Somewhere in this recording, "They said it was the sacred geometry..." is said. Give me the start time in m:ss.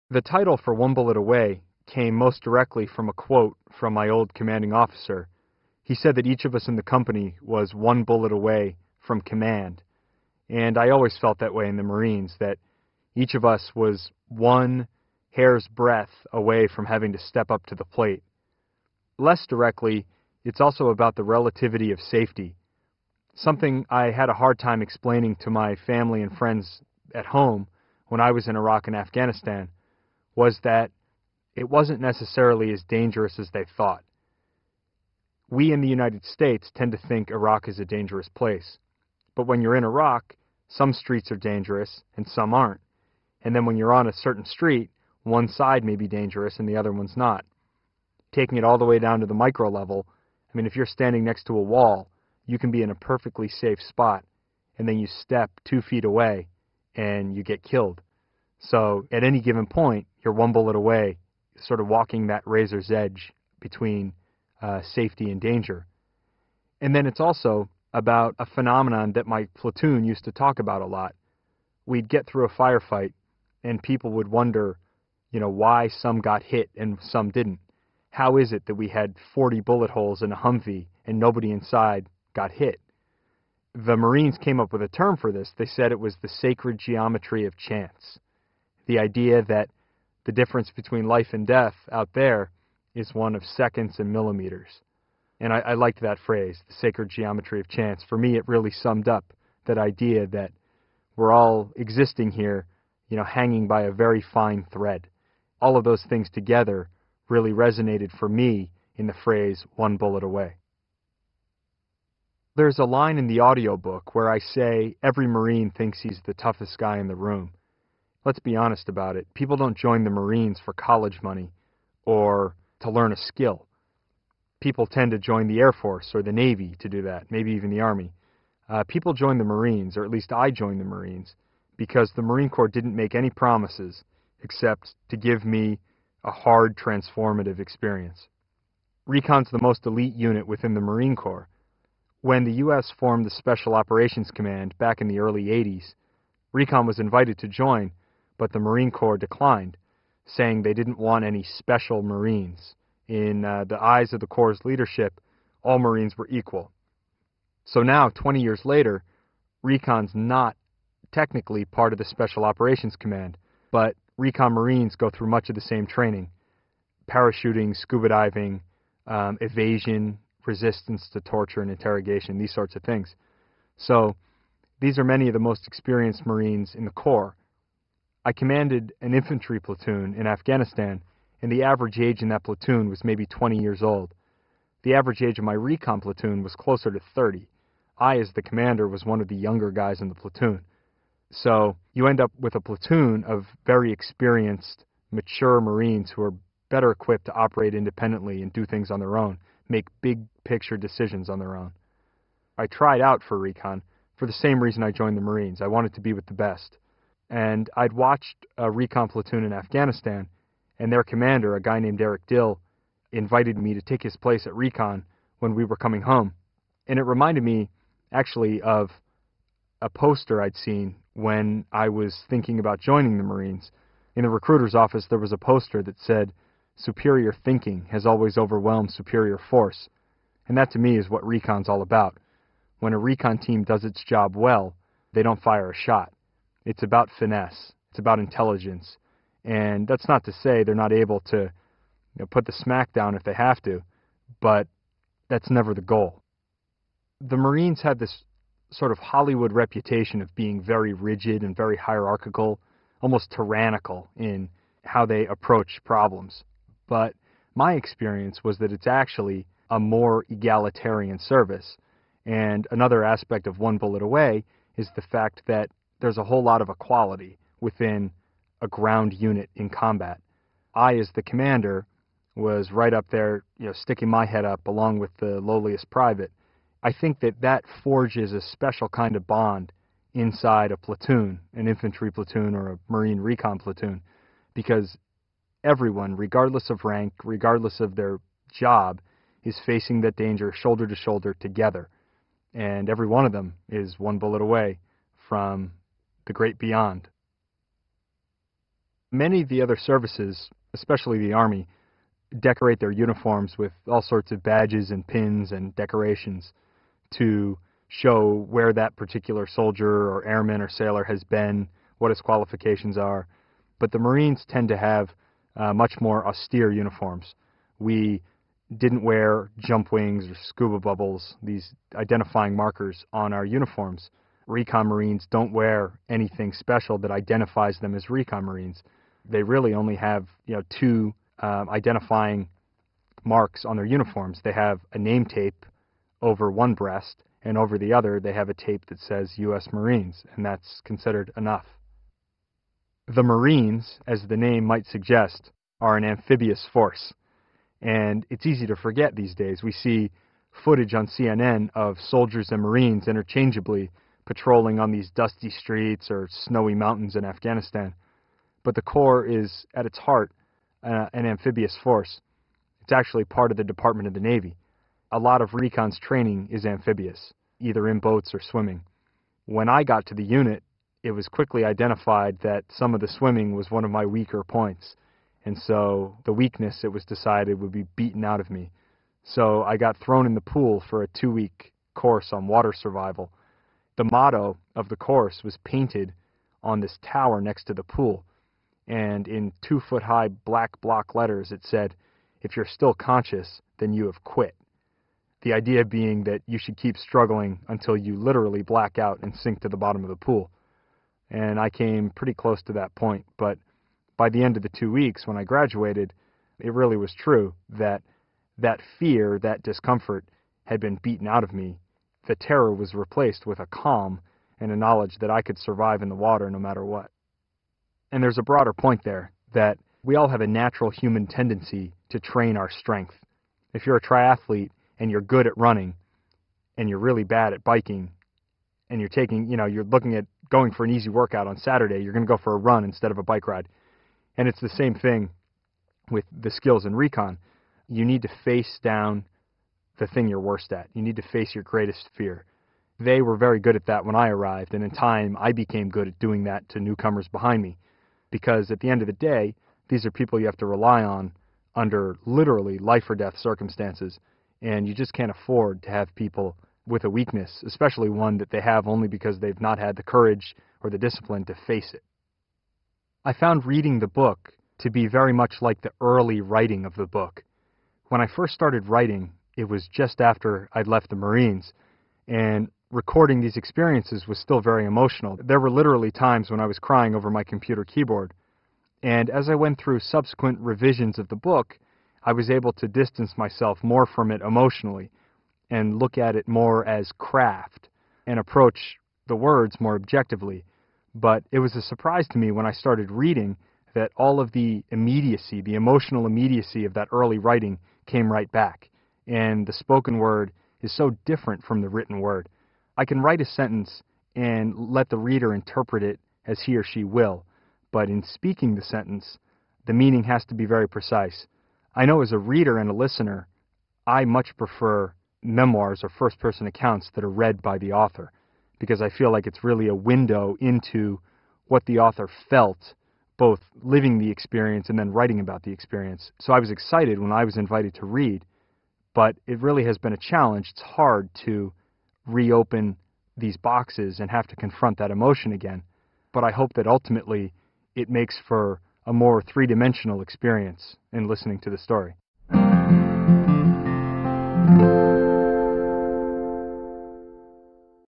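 1:25.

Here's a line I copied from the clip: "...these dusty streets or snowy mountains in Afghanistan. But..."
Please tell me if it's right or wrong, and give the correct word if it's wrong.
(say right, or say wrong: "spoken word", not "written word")
right.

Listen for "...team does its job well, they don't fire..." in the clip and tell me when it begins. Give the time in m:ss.
3:53.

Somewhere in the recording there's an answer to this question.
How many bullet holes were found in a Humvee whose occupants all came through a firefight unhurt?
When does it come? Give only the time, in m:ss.
1:19.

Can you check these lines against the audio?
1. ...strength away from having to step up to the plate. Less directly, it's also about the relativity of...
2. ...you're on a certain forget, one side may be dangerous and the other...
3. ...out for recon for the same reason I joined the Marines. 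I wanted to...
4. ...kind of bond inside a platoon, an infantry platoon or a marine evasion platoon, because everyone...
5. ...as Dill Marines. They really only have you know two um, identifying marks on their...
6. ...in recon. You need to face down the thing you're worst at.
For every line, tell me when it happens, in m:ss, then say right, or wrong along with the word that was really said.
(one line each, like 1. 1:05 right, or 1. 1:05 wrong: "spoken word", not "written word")
1. 0:15 wrong: "breadth", not "strength"
2. 0:43 wrong: "street", not "forget"
3. 3:23 right
4. 4:38 wrong: "recon", not "evasion"
5. 5:27 wrong: "Recon", not "Dill"
6. 7:16 right.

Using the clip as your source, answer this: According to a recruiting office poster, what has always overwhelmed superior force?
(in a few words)
Superior thinking.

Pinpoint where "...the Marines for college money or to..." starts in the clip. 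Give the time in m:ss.
2:00.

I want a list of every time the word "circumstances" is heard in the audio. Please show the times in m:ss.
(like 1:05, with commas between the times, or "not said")
7:33.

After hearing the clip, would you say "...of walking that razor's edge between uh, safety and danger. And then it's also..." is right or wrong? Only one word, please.
right.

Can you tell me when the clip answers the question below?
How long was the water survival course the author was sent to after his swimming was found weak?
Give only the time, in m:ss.
6:21.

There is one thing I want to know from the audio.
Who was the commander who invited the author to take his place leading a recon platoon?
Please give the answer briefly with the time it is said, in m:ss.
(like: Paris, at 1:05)
Eric Dill, at 3:32.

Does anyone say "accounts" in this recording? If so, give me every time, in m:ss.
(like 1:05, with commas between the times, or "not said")
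8:36.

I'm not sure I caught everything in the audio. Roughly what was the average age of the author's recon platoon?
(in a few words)
30.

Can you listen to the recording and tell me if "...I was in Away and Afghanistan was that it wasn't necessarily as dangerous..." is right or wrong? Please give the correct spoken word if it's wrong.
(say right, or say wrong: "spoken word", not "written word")
wrong: "Iraq", not "Away".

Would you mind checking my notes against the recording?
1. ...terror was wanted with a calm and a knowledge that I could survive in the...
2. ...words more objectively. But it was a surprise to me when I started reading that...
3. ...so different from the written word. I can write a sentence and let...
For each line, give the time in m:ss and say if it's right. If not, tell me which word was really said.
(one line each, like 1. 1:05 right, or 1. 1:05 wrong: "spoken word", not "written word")
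1. 6:52 wrong: "replaced", not "wanted"
2. 8:09 right
3. 8:20 right.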